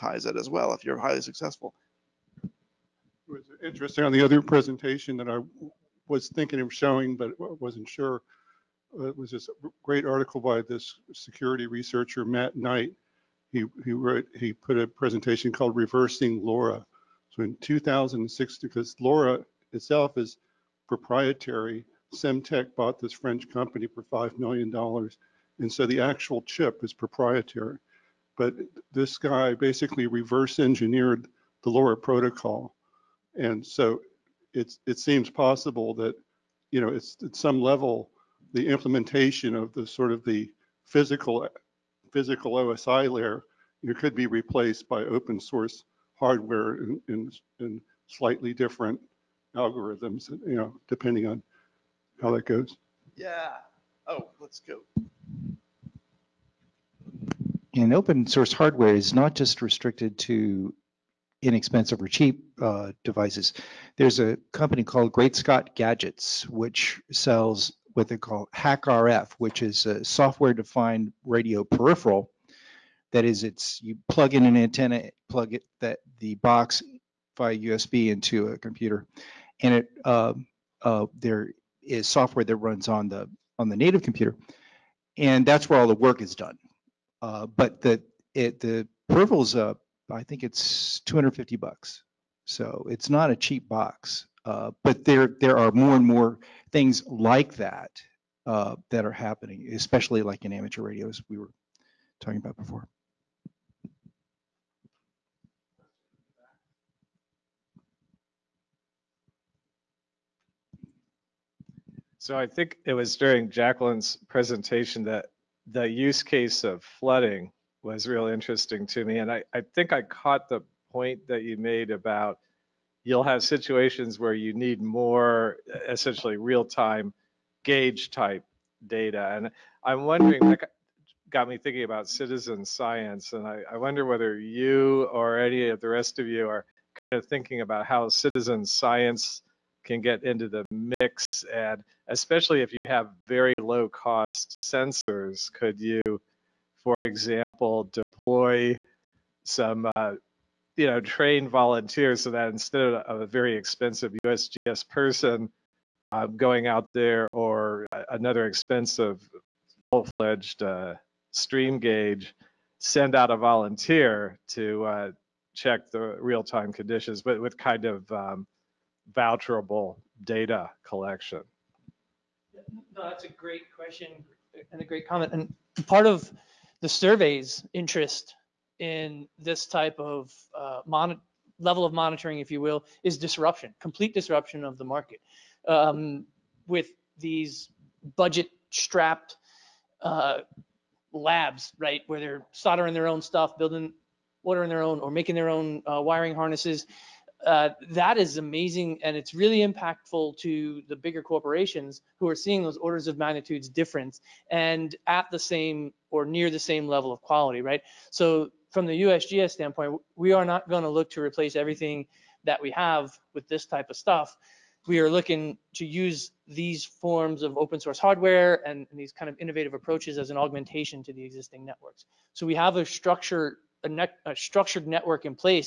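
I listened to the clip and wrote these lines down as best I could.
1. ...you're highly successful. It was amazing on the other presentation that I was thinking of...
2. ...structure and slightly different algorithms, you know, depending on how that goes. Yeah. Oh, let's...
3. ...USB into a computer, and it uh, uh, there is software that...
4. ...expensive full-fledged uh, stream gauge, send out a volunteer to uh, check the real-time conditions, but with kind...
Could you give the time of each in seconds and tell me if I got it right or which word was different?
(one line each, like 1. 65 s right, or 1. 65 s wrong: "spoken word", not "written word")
1. 0 s wrong: "interesting", not "amazing"
2. 46 s wrong: "hardware", not "structure"
3. 77 s right
4. 158 s right.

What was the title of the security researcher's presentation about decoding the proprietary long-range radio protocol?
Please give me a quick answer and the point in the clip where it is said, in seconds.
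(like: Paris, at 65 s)
Reversing LoRa, at 15 s.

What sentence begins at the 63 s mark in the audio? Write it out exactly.
There's a company called Great Scott Gadgets, which sells what they call HackRF, which is a software-defined radio peripheral.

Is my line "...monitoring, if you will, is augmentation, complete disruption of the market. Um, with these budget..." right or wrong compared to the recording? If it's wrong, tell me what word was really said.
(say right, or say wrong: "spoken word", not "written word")
wrong: "disruption", not "augmentation".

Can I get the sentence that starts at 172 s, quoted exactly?
No, that's a great question and a great comment.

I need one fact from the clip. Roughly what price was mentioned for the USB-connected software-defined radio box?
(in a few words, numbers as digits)
$250.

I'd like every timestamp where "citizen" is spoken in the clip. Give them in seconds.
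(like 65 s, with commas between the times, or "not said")
132 s, 138 s.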